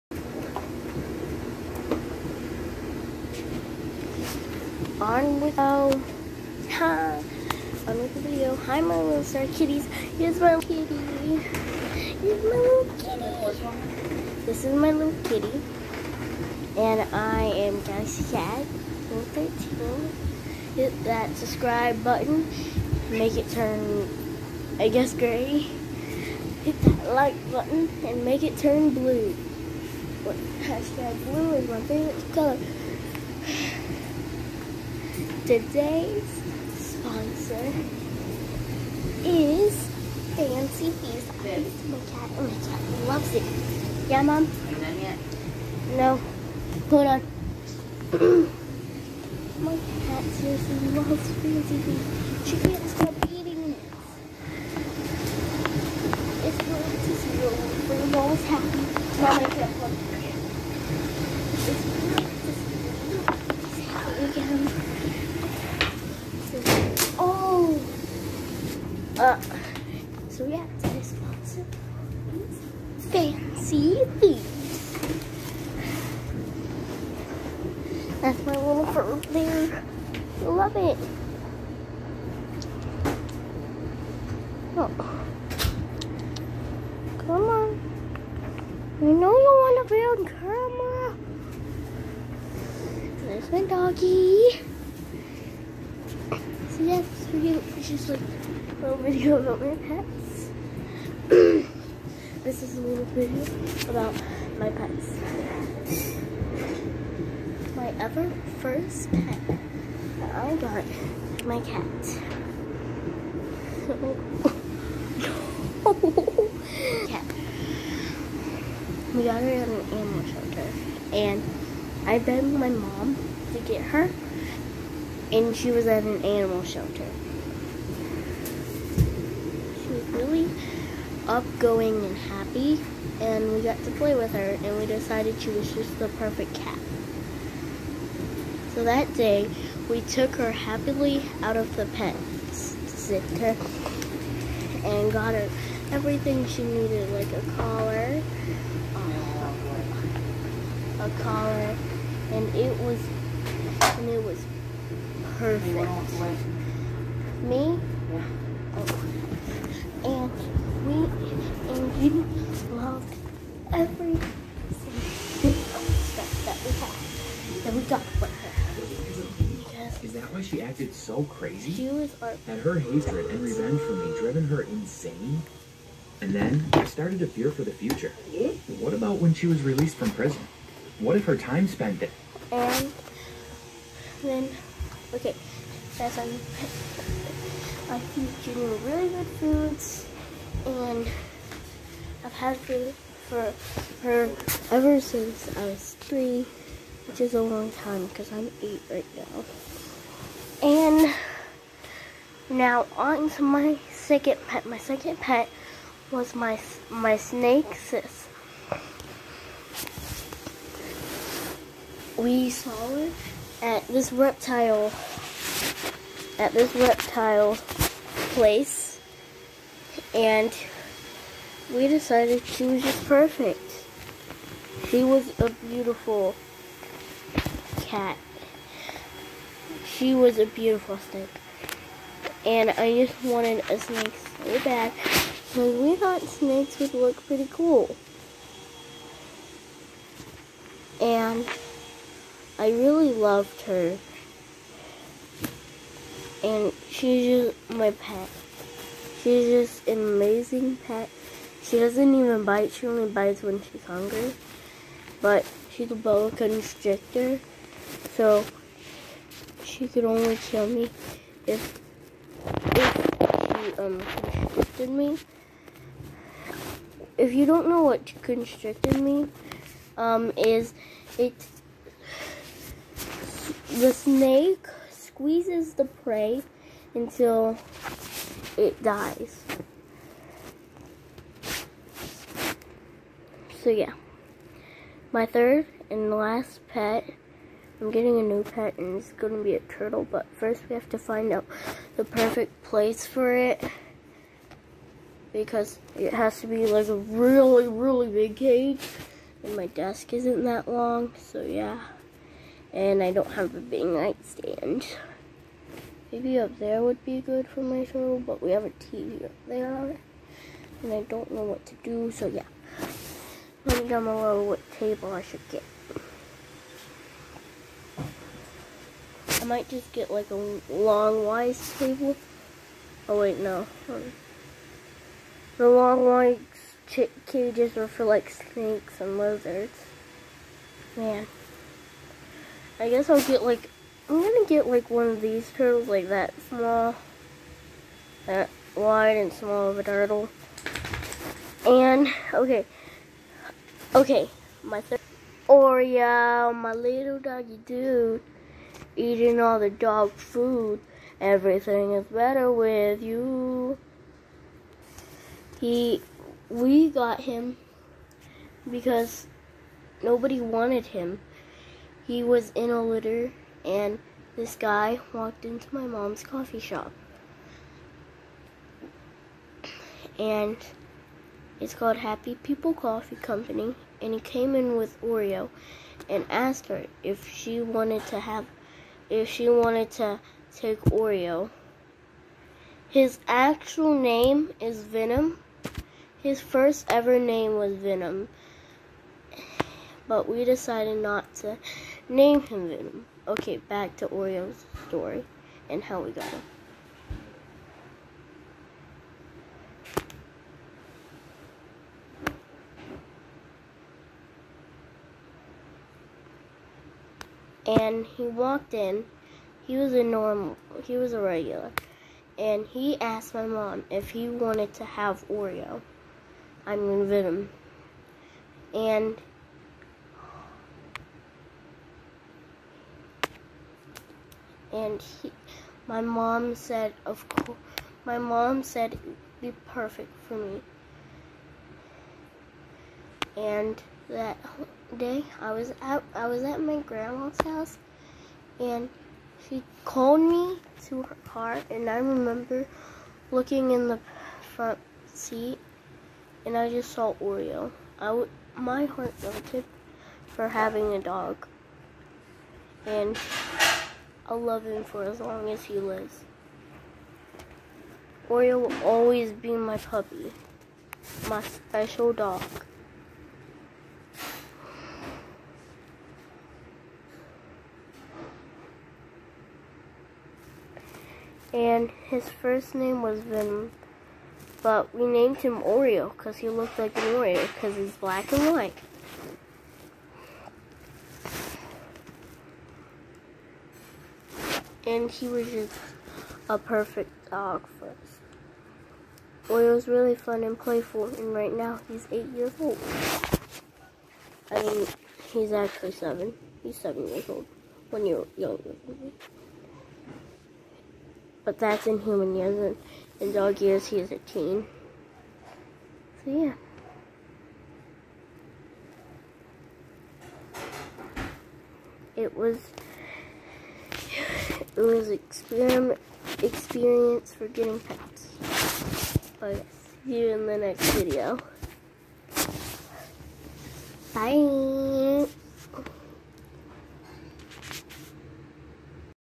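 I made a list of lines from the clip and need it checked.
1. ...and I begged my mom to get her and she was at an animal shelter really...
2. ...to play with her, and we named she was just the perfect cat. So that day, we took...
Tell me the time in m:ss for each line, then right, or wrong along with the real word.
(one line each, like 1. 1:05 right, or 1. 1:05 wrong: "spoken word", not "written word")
1. 2:01 right
2. 2:13 wrong: "decided", not "named".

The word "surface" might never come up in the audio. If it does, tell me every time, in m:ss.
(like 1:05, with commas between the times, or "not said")
not said.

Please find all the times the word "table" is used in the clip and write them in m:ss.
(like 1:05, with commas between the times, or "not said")
5:14, 5:21.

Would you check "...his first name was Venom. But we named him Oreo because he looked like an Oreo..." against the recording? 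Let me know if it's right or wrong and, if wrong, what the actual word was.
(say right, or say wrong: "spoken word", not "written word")
right.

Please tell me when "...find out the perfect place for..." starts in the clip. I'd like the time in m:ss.
4:50.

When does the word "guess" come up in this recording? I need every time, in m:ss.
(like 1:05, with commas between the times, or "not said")
0:24, 5:32.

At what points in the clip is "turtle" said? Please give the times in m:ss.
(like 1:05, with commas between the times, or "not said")
4:49, 5:07, 5:35, 5:39.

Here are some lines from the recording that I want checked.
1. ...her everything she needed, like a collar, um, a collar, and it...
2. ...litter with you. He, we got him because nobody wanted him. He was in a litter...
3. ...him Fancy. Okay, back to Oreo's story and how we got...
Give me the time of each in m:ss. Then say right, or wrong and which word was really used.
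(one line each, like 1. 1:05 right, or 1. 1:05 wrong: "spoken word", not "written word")
1. 2:25 right
2. 5:52 wrong: "better", not "litter"
3. 6:32 wrong: "Venom", not "Fancy".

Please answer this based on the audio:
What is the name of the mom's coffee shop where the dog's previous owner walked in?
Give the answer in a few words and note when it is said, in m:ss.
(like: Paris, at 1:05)
Happy People Coffee Company, at 6:11.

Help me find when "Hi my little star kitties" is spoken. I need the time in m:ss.
0:08.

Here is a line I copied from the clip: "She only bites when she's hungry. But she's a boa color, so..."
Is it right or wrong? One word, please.
wrong.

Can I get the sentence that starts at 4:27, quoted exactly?
If you don't know what constricted me, um, is it the snake squeezes the prey until it dies.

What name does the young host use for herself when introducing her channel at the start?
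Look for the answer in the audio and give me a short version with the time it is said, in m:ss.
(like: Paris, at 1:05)
Galaxy Cat 13, at 0:17.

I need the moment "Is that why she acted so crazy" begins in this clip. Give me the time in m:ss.
2:50.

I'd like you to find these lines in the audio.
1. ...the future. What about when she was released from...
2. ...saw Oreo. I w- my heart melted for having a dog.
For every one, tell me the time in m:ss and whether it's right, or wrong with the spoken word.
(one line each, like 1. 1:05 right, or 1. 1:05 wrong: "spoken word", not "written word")
1. 2:57 right
2. 7:26 right.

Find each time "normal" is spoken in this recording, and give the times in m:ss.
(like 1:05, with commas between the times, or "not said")
6:50.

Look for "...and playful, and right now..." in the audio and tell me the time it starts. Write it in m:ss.
8:10.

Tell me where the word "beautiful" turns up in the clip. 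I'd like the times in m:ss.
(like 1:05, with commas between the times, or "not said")
3:45, 3:50.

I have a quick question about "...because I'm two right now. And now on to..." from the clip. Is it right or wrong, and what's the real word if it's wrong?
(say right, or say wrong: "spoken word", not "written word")
wrong: "eight", not "two".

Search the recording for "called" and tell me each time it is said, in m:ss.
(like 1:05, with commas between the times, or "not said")
6:11, 7:19.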